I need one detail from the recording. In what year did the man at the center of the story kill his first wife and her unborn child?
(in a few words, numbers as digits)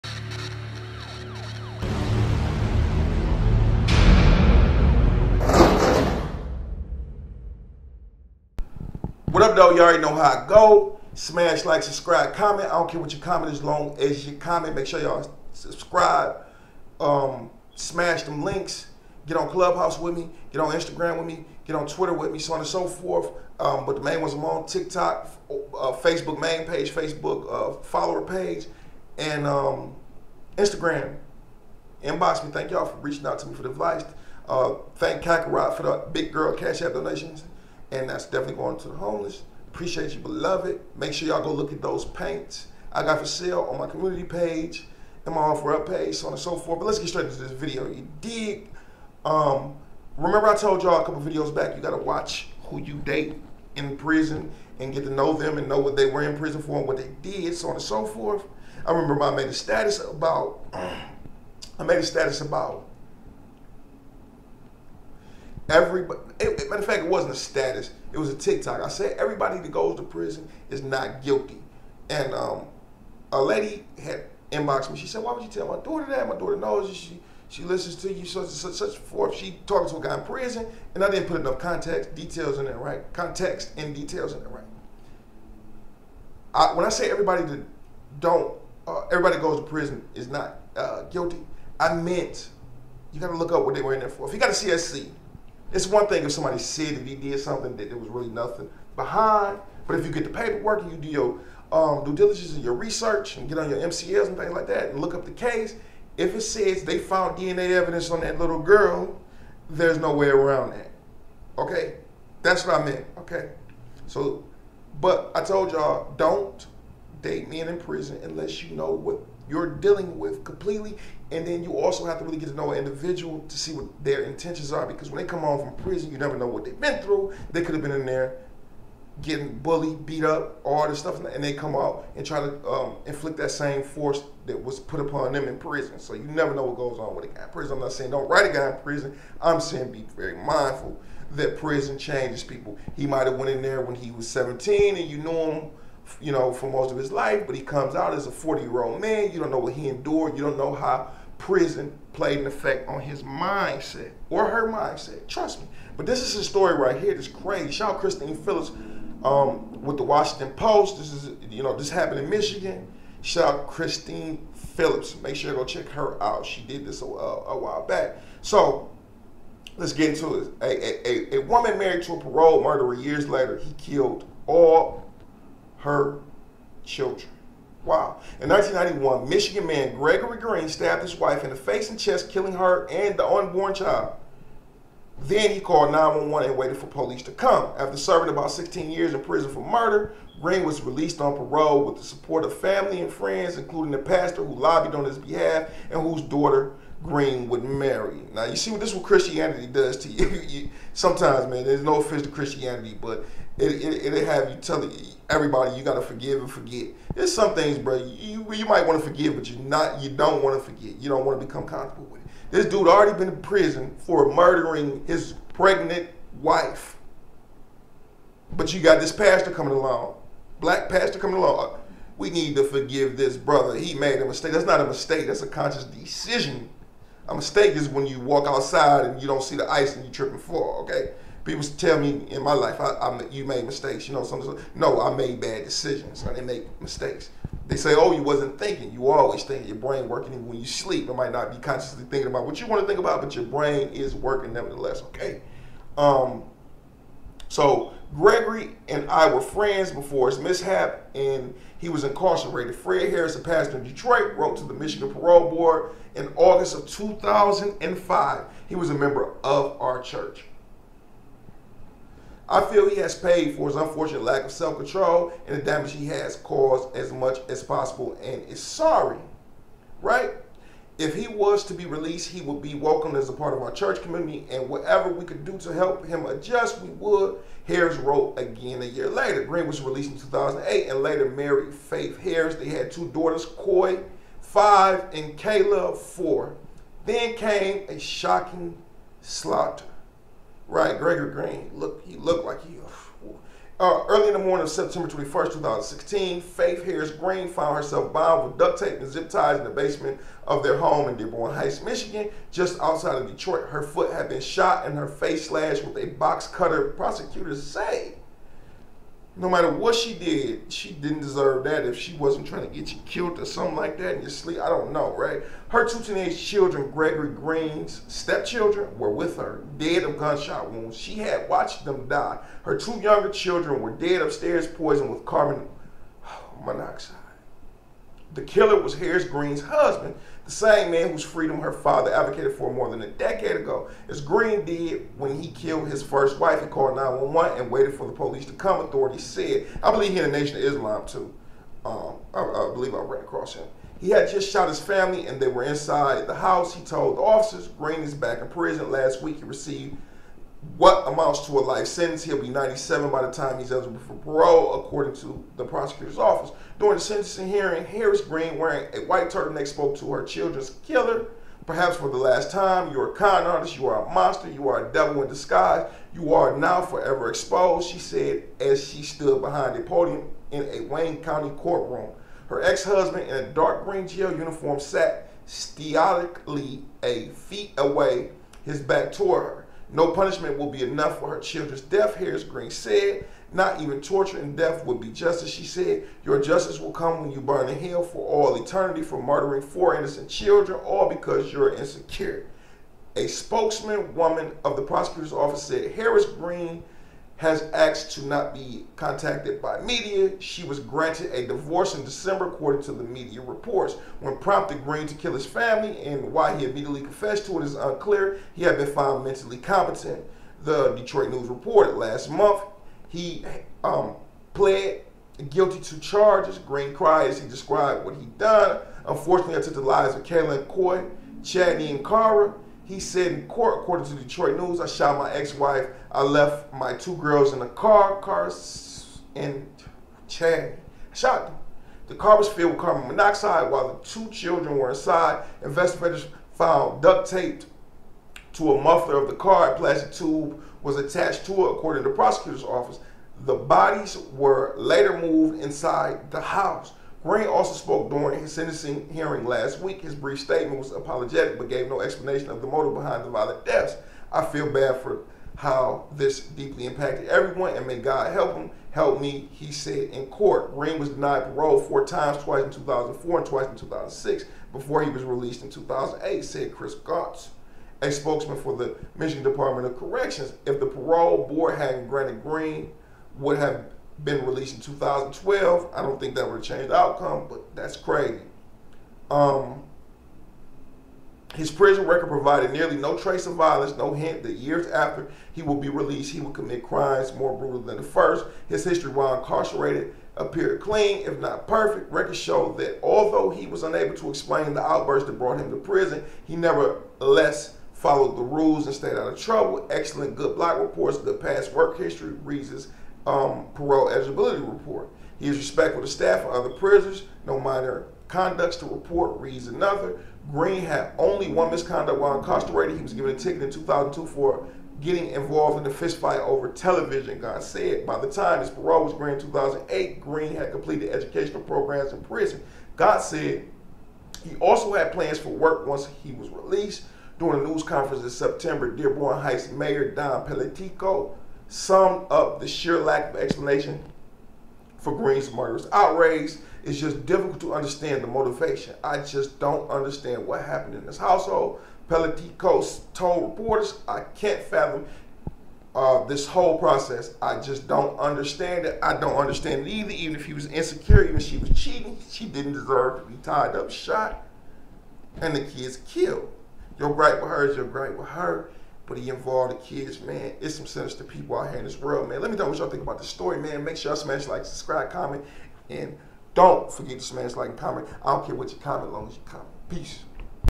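1991.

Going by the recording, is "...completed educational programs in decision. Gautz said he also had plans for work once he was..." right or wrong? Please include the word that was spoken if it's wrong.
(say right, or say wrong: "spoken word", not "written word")
wrong: "prison", not "decision".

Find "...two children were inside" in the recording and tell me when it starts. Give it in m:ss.
7:14.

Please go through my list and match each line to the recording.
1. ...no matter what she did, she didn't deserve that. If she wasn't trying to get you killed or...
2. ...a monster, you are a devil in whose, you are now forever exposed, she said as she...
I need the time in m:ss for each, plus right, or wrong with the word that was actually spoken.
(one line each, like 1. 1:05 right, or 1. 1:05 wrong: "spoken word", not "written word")
1. 5:09 right
2. 6:04 wrong: "disguise", not "whose".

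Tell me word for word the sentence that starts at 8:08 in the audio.
His history while incarcerated appeared clean, if not perfect.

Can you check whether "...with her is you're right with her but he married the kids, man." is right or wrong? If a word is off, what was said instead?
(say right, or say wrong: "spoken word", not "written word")
wrong: "involved", not "married".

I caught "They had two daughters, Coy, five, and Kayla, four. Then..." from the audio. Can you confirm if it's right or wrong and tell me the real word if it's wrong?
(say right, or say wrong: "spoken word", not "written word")
right.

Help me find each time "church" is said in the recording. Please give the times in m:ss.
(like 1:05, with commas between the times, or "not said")
4:20, 4:33.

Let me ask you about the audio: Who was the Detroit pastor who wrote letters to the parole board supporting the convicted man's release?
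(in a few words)
Fred Harris.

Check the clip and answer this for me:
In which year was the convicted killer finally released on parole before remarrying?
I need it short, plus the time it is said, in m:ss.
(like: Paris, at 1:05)
2008, at 4:39.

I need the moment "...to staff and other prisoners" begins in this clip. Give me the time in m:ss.
8:26.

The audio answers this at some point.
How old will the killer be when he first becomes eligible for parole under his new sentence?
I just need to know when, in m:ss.
5:52.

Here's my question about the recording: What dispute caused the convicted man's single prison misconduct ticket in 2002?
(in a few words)
A fistfight over television.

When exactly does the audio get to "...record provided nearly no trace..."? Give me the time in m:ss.
8:02.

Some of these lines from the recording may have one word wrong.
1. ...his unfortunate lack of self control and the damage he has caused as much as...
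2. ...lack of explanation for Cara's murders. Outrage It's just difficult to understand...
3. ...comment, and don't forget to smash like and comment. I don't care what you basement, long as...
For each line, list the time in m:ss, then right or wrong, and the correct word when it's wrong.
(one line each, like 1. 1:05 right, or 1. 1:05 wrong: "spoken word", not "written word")
1. 4:23 right
2. 8:52 wrong: "Green", not "Cara"
3. 9:25 wrong: "comment", not "basement".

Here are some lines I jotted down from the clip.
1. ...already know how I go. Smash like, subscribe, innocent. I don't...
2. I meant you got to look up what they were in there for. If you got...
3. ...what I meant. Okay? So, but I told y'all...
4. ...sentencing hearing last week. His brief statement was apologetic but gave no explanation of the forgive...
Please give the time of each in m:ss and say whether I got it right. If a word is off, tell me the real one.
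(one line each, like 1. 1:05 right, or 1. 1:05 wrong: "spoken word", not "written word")
1. 0:09 wrong: "comment", not "innocent"
2. 1:31 right
3. 1:52 right
4. 7:28 wrong: "motive", not "forgive".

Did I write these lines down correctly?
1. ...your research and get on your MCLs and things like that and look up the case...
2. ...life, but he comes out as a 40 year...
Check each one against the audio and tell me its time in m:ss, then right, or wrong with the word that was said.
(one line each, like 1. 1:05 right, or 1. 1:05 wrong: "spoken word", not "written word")
1. 1:42 right
2. 2:27 right.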